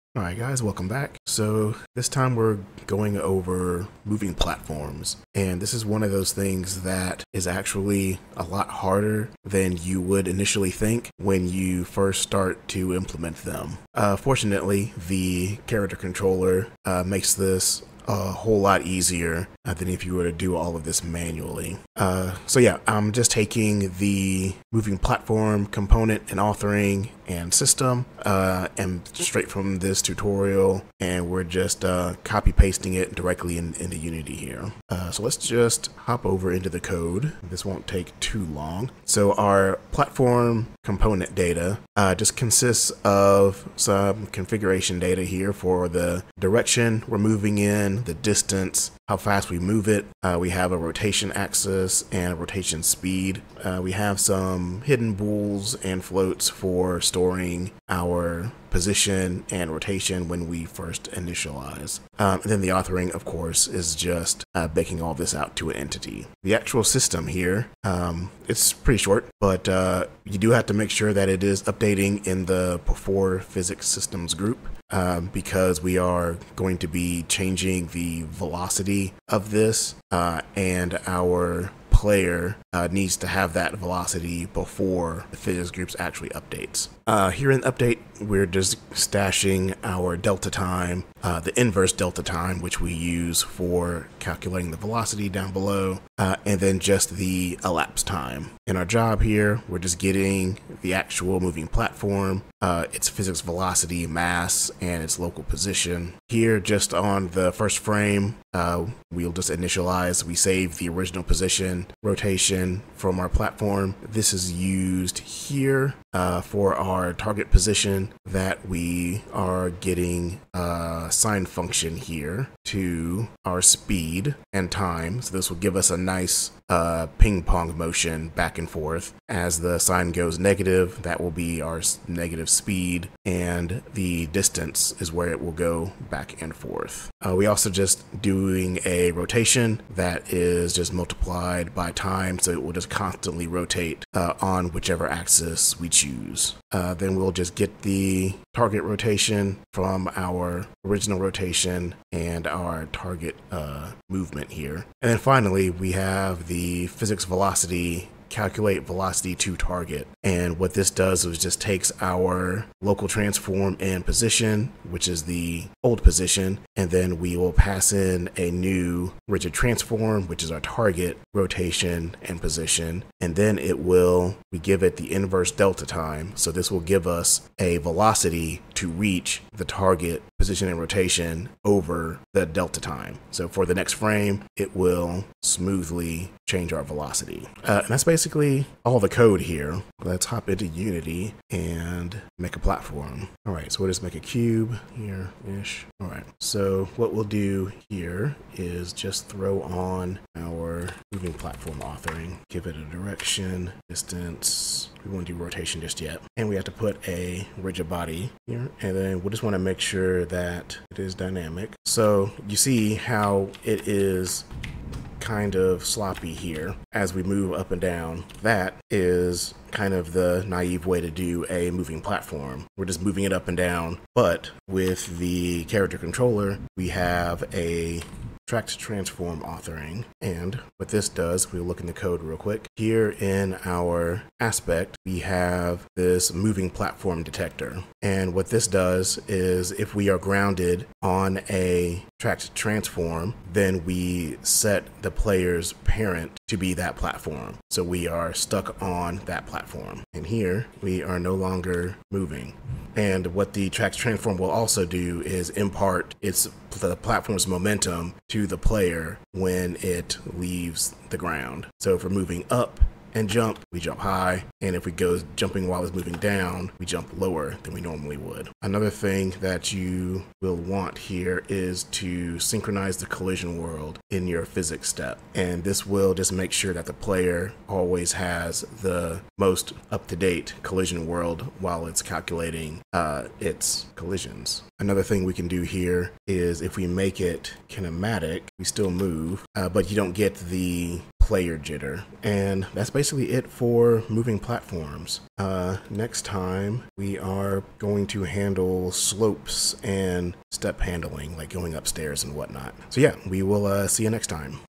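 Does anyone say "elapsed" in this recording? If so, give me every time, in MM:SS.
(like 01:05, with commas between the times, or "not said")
01:37.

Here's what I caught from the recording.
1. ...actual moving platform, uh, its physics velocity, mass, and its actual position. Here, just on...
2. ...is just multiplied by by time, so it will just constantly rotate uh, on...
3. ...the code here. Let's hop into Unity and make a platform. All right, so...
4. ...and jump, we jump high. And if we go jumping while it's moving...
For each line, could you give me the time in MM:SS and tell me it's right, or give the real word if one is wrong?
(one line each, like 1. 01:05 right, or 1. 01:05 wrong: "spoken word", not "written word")
1. 01:40 wrong: "local", not "actual"
2. 02:20 right
3. 03:08 right
4. 04:23 right.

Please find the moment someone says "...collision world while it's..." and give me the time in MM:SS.
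04:40.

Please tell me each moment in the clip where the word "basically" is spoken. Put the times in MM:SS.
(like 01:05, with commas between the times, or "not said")
03:08, 04:52.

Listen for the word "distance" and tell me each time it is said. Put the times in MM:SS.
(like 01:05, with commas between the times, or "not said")
00:48, 02:14, 03:23.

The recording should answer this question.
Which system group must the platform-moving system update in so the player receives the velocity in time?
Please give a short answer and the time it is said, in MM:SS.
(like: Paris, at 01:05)
Before physics systems group, at 01:12.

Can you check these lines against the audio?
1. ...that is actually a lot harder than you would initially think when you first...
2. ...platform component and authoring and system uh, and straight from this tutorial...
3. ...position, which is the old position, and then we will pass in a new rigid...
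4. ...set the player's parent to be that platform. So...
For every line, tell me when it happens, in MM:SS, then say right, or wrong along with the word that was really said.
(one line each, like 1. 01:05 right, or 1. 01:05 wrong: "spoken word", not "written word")
1. 00:06 right
2. 00:24 right
3. 02:44 right
4. 04:04 right.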